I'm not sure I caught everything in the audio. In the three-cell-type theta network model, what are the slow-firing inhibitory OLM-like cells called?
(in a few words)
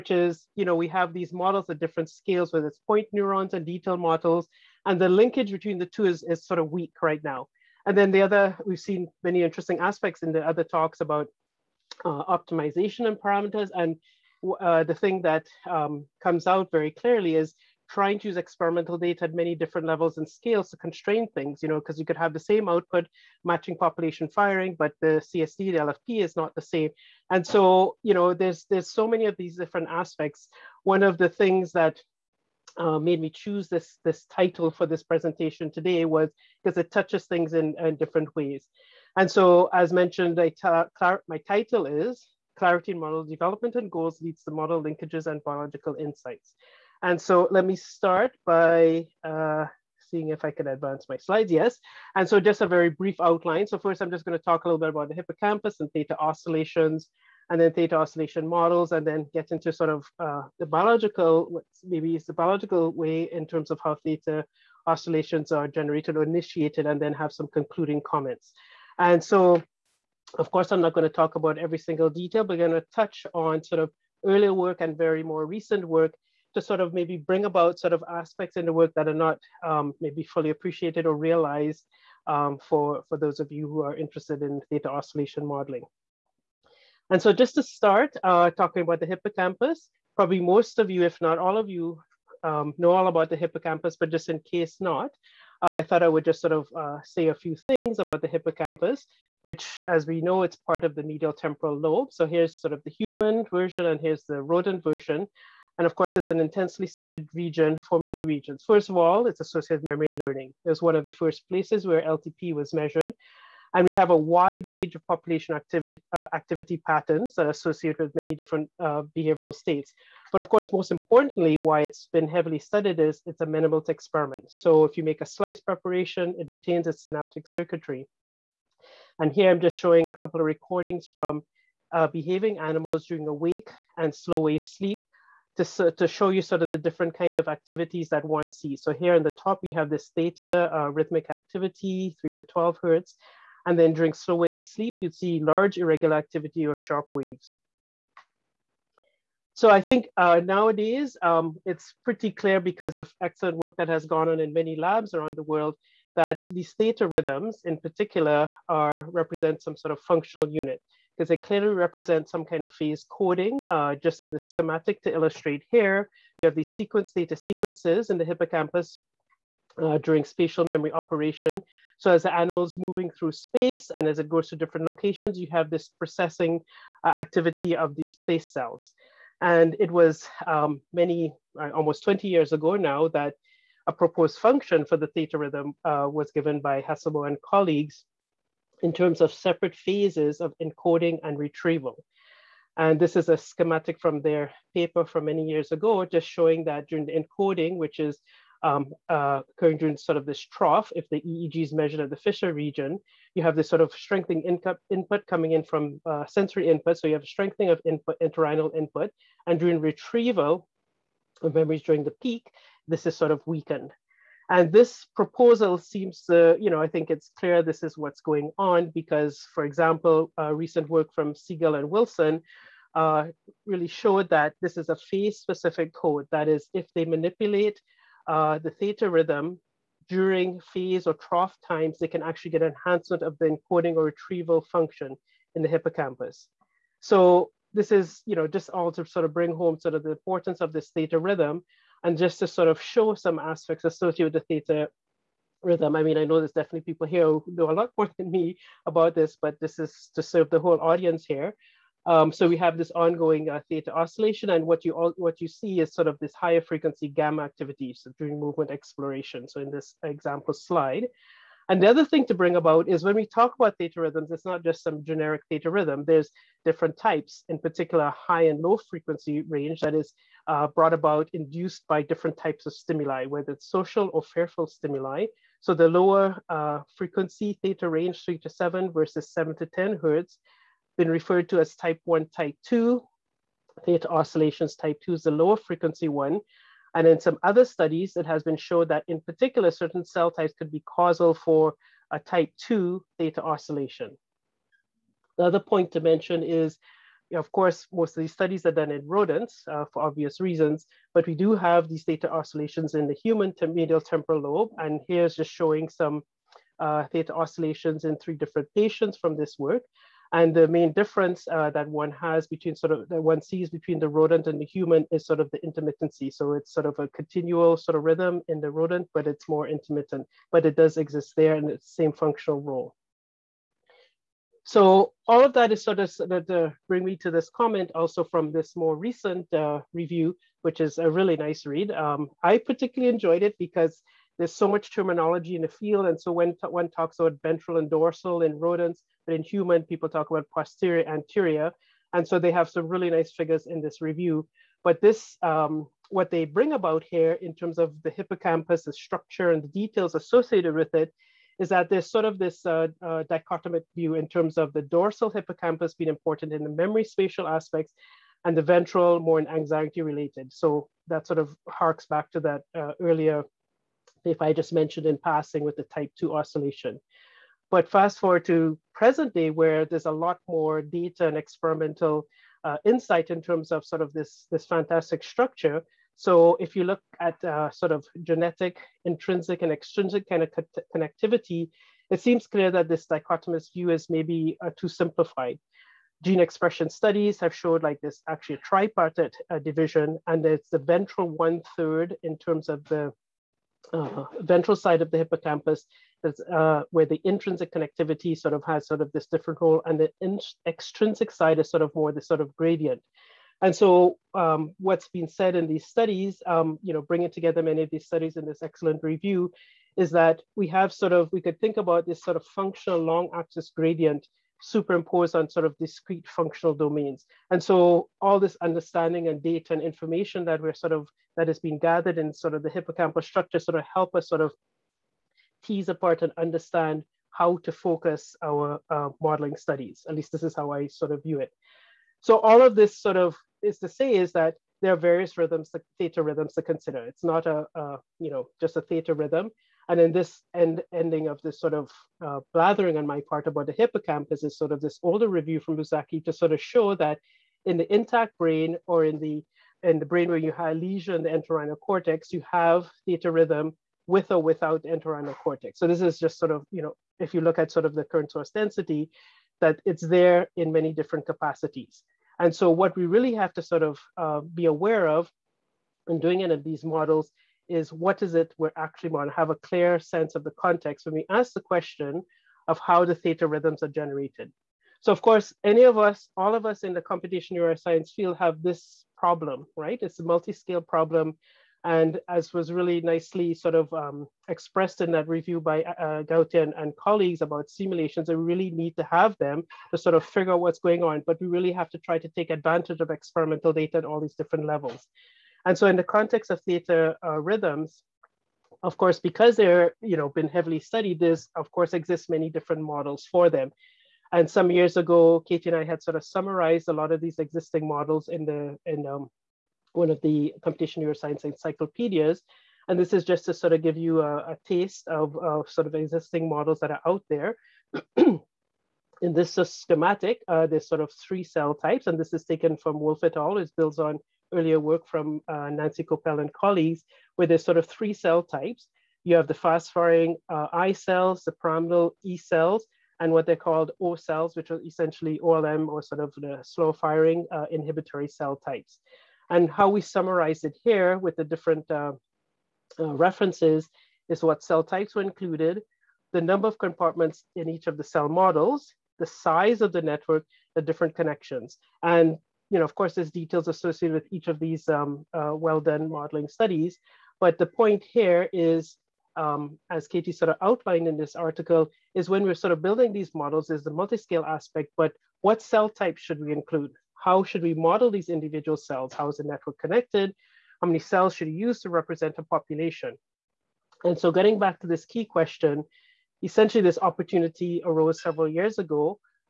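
O cells.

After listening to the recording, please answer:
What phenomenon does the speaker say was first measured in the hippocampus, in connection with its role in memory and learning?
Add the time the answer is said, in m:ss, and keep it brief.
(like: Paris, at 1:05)
LTP, at 1:52.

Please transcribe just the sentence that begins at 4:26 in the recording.
There's different types, in particular high and low frequency range.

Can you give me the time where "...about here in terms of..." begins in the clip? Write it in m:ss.
5:46.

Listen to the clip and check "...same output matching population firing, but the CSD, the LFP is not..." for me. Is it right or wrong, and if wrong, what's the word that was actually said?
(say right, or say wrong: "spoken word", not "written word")
right.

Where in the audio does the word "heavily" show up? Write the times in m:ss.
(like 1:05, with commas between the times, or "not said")
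2:02, 8:20.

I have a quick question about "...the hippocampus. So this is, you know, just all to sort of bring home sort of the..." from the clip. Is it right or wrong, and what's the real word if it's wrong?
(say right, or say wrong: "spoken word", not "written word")
right.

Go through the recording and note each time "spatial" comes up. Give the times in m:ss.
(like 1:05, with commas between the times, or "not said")
2:50, 5:57.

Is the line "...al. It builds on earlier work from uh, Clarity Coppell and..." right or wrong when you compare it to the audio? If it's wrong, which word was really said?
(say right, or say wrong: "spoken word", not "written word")
wrong: "Nancy", not "Clarity".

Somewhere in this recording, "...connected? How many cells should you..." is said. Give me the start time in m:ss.
9:29.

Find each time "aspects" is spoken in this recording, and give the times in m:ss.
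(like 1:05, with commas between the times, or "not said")
0:09, 0:29, 1:18, 4:03, 5:57, 9:24.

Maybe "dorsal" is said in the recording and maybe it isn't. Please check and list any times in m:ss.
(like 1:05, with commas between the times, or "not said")
5:37, 5:54.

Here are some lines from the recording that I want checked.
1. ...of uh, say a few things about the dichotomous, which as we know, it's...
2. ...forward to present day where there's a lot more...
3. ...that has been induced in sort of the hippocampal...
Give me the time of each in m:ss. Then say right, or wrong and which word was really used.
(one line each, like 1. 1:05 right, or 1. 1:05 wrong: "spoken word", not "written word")
1. 1:36 wrong: "hippocampus", not "dichotomous"
2. 6:08 right
3. 7:01 wrong: "gathered", not "induced".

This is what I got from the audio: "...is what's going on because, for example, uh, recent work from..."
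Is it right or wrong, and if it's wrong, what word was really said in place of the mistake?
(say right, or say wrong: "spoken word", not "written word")
right.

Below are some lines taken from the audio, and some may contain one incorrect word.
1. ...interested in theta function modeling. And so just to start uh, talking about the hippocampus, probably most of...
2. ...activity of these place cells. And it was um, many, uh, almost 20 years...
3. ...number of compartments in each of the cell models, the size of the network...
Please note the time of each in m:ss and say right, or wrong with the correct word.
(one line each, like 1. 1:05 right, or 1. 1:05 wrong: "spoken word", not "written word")
1. 1:23 wrong: "oscillation", not "function"
2. 2:57 right
3. 9:06 right.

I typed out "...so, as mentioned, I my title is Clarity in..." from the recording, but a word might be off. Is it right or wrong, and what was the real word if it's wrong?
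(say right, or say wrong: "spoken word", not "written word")
right.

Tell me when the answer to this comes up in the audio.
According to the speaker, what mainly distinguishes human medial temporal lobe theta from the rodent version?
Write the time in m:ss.
5:15.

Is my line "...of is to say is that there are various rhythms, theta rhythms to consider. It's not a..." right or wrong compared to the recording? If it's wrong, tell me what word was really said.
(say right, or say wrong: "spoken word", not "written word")
right.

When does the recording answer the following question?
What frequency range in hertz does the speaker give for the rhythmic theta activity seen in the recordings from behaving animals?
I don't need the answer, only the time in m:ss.
2:22.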